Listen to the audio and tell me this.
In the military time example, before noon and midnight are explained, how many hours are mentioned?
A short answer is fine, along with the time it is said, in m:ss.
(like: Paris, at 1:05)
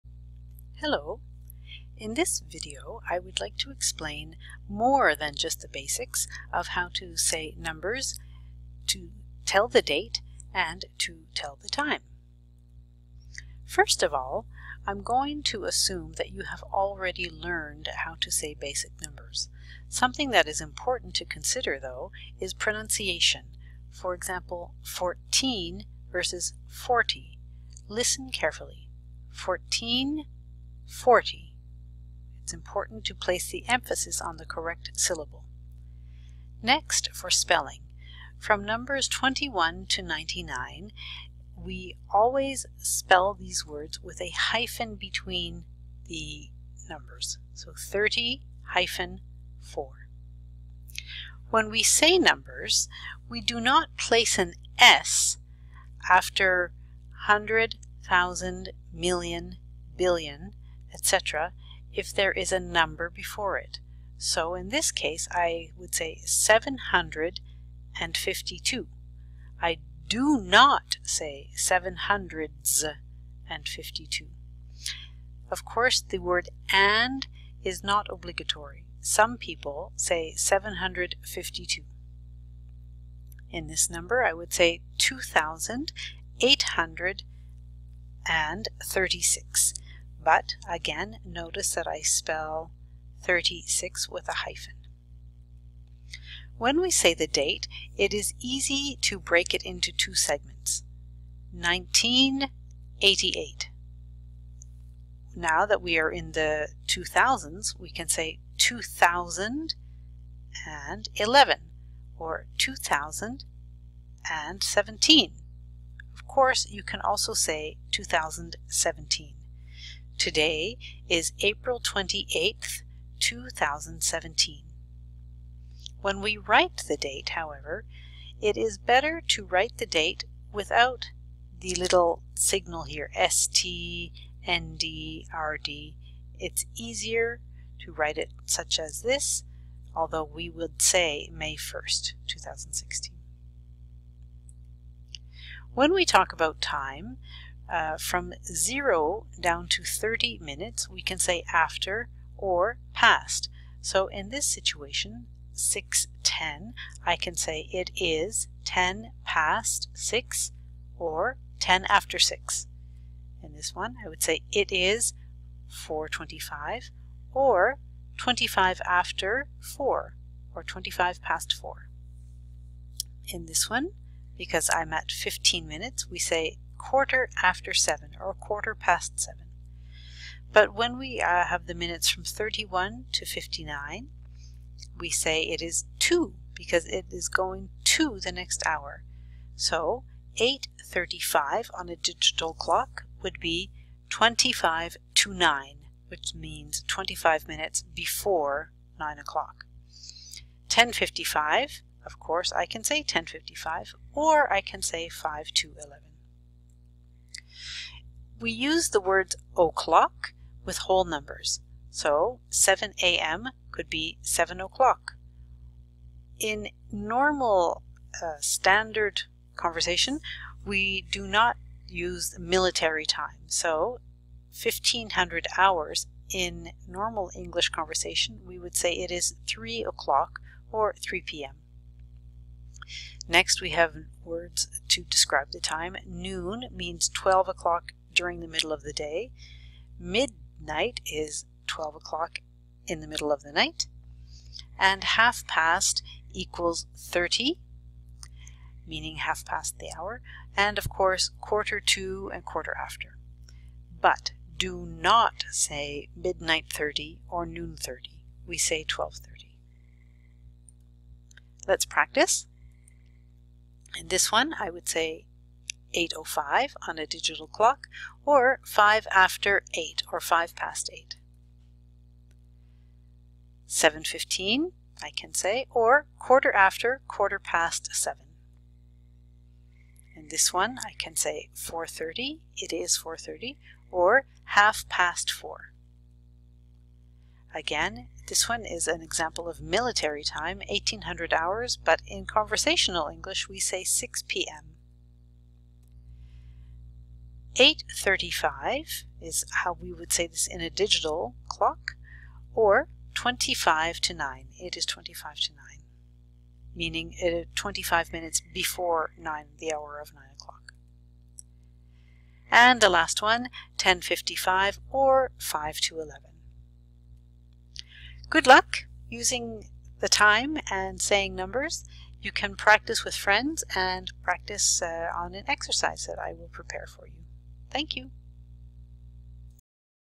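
1500 hours, at 3:44.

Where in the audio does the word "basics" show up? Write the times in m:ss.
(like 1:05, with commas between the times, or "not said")
0:05, 0:18.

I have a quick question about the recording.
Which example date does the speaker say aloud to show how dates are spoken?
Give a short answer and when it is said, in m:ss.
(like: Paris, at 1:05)
May 1st, 2016, at 2:21.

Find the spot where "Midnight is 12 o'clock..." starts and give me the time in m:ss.
3:59.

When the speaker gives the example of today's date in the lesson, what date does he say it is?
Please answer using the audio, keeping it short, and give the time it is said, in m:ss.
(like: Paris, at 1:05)
April 28th, 2017, at 2:01.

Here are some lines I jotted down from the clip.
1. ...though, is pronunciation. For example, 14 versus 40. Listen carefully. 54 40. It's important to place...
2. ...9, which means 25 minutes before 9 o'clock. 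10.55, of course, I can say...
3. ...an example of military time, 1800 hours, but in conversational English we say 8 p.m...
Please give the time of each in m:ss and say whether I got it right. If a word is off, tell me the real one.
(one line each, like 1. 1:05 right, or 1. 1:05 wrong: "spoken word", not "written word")
1. 0:21 wrong: "14", not "54"
2. 3:15 right
3. 4:48 wrong: "6", not "8".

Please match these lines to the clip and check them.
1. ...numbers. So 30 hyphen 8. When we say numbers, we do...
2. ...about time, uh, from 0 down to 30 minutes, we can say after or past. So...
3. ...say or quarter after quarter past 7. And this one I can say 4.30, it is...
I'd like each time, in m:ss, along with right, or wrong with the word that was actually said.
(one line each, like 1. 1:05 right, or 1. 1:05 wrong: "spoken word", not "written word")
1. 0:46 wrong: "4", not "8"
2. 2:26 right
3. 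4:35 right.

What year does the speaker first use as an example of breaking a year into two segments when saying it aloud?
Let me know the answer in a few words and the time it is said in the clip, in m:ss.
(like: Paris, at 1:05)
1988, at 1:41.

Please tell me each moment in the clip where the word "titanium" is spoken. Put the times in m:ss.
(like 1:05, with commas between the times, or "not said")
not said.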